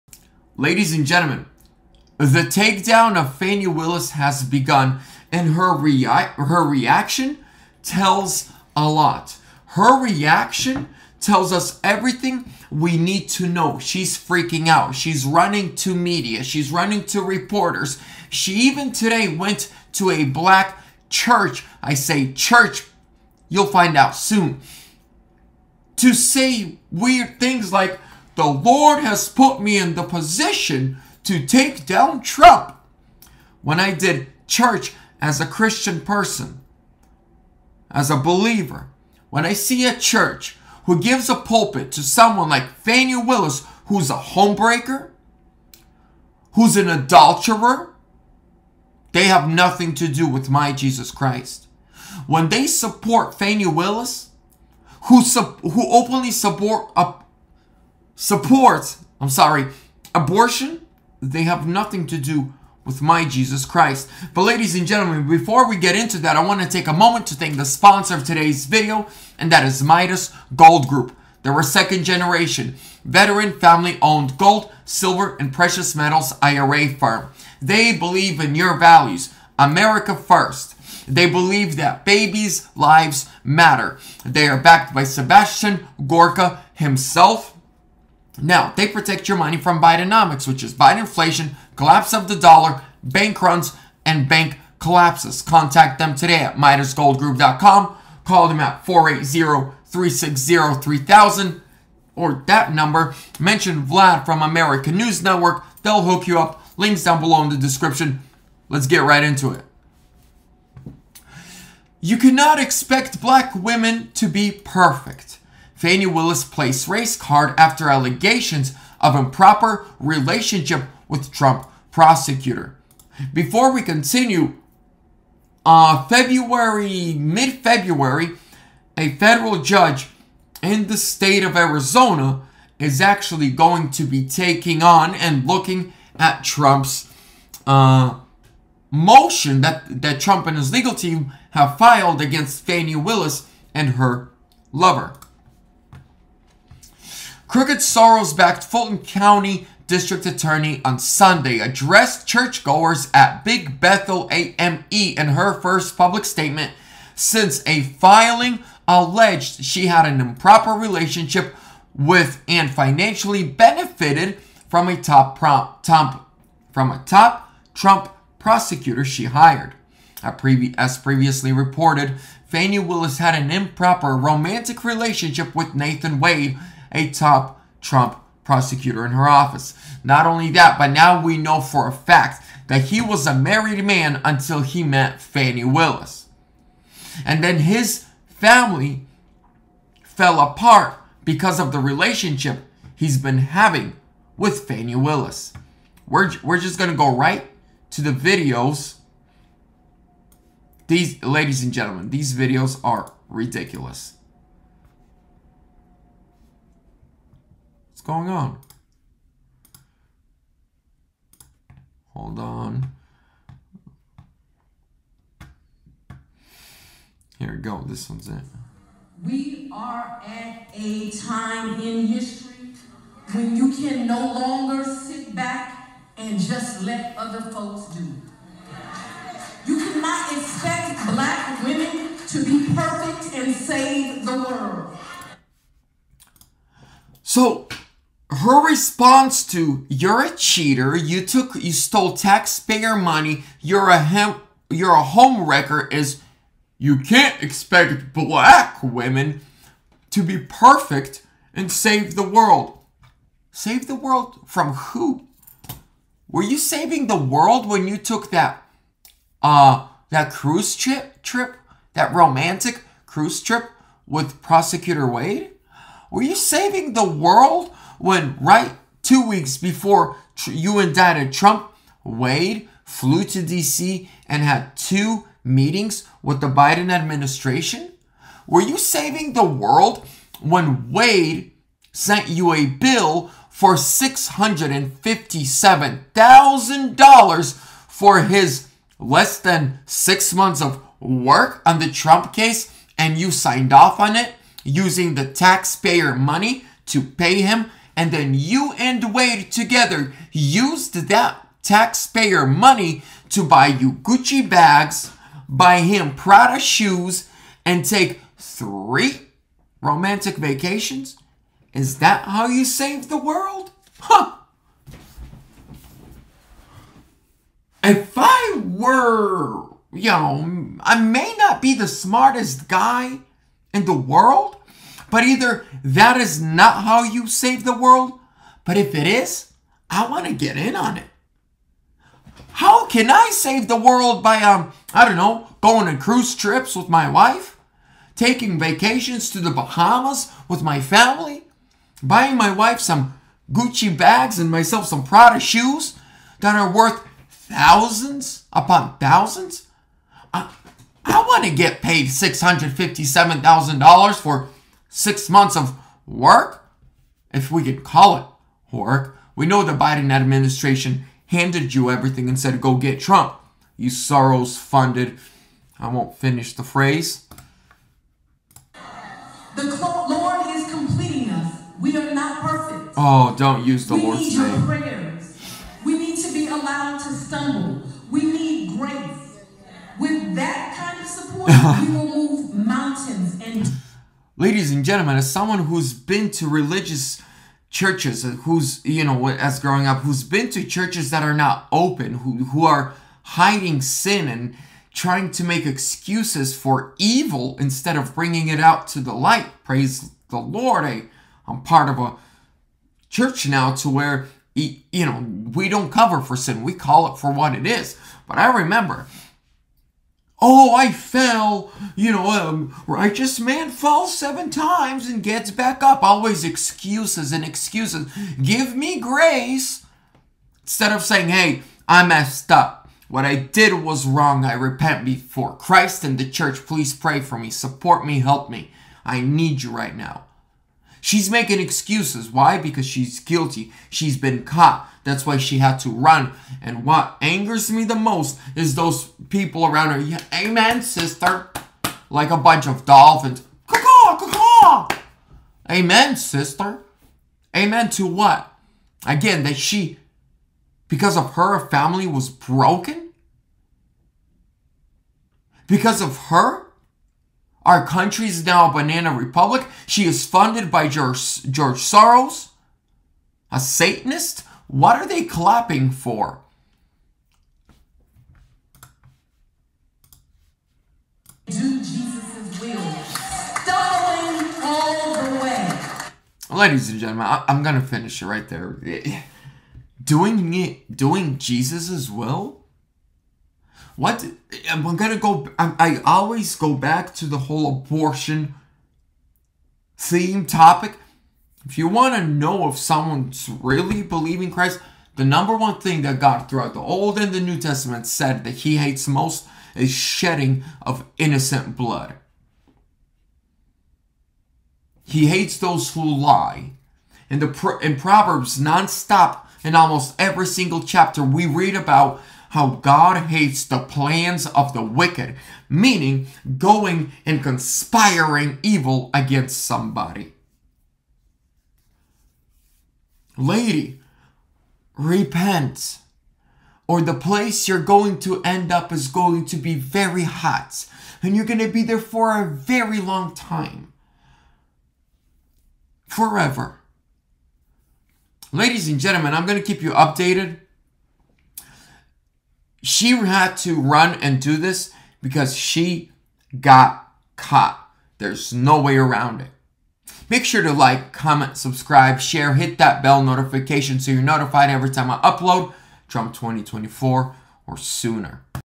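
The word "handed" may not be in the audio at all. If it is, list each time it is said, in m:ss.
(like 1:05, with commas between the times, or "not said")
6:01.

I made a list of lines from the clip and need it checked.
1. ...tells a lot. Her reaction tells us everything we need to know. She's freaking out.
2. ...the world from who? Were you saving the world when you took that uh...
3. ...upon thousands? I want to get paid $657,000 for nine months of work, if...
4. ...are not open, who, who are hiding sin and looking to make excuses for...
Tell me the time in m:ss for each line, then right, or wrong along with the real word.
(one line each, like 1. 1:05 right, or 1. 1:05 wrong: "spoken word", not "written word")
1. 0:07 right
2. 4:13 right
3. 5:48 wrong: "six", not "nine"
4. 6:31 wrong: "trying", not "looking".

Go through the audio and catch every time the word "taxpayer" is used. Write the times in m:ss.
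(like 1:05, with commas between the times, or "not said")
4:02, 4:55, 5:01.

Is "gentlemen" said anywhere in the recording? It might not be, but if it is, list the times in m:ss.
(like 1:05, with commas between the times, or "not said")
0:01, 1:04, 3:21, 6:24, 7:56, 8:58.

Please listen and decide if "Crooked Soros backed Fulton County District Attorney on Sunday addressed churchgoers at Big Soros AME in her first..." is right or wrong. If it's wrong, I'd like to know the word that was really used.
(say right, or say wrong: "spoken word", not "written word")
wrong: "Bethel", not "Soros".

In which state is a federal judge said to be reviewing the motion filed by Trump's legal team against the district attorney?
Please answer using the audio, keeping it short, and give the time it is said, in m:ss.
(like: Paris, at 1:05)
Arizona, at 2:11.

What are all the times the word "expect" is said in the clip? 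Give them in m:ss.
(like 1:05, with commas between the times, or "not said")
1:52, 3:50, 4:07.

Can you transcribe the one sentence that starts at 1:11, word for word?
They're a second generation, veteran, family-owned gold, silver, and precious metals IRA firm.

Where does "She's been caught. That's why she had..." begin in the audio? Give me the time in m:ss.
7:13.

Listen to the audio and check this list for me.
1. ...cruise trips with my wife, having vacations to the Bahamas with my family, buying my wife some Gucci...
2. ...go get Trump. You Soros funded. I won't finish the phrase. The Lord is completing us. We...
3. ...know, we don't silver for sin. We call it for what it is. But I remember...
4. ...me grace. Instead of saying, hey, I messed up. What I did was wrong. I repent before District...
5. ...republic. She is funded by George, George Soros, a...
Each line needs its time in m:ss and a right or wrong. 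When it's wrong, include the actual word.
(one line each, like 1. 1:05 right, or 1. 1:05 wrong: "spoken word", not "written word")
1. 5:35 wrong: "taking", not "having"
2. 6:02 right
3. 6:45 wrong: "cover", not "silver"
4. 6:58 wrong: "Christ", not "District"
5. 7:39 right.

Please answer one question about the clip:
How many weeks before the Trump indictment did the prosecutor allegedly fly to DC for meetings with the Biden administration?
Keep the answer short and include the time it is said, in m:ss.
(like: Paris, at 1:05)
2, at 4:29.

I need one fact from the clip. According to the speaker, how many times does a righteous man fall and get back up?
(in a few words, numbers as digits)
7.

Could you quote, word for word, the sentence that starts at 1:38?
Call them at 480-360-3000 or that number.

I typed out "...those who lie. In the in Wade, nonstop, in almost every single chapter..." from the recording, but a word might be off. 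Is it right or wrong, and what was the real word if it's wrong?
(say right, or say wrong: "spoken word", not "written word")
wrong: "Proverbs", not "Wade".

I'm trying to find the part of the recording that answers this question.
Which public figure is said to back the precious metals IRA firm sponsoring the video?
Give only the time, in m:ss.
1:25.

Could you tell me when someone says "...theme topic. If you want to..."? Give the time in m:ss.
8:09.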